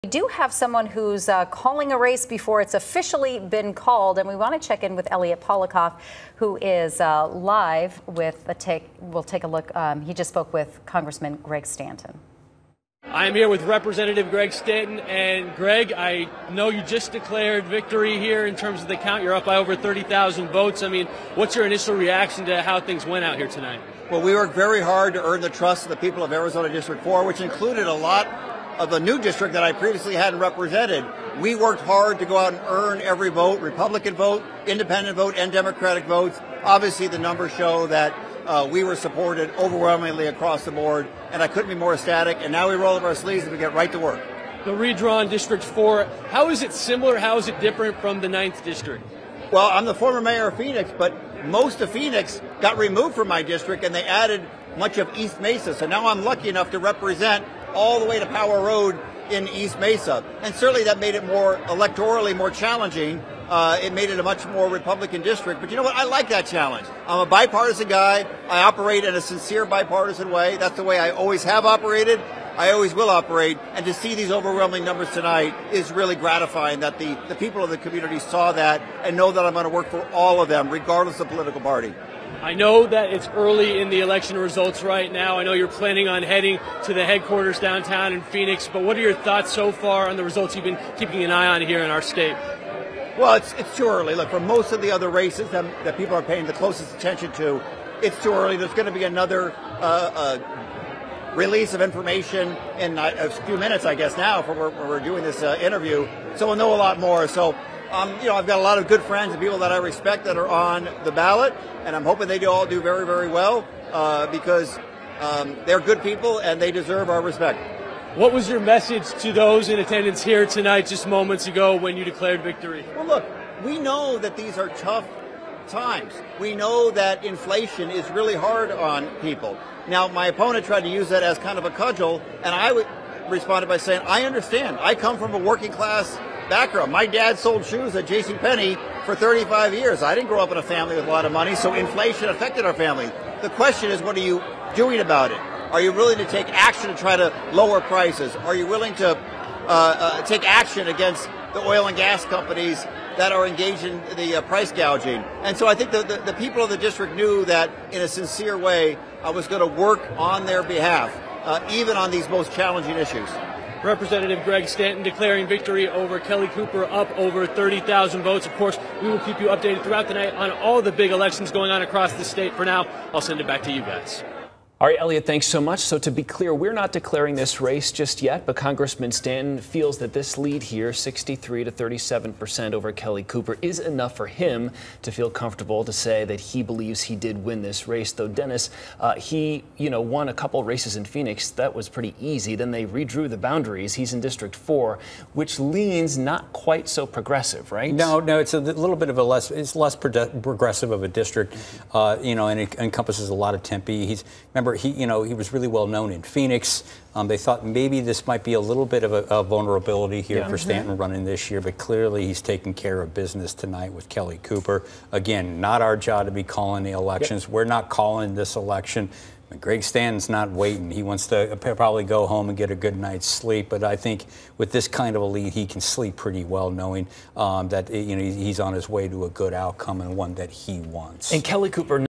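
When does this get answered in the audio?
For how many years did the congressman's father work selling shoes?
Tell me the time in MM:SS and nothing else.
02:19.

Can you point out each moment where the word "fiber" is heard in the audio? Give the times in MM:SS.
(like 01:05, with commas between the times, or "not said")
not said.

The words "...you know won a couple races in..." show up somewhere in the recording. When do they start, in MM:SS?
03:09.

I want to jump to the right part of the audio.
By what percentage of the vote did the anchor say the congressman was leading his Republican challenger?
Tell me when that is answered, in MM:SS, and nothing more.
03:00.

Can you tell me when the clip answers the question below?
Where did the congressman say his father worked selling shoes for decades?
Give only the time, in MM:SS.
02:18.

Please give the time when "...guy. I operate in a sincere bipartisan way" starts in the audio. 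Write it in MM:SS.
01:07.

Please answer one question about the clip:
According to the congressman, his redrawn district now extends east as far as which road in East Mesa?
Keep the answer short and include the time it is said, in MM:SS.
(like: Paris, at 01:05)
Power Road, at 00:58.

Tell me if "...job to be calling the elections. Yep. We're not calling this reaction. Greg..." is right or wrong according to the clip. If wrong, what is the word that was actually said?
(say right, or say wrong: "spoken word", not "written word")
wrong: "election", not "reaction".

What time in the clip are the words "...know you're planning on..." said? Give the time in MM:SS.
01:25.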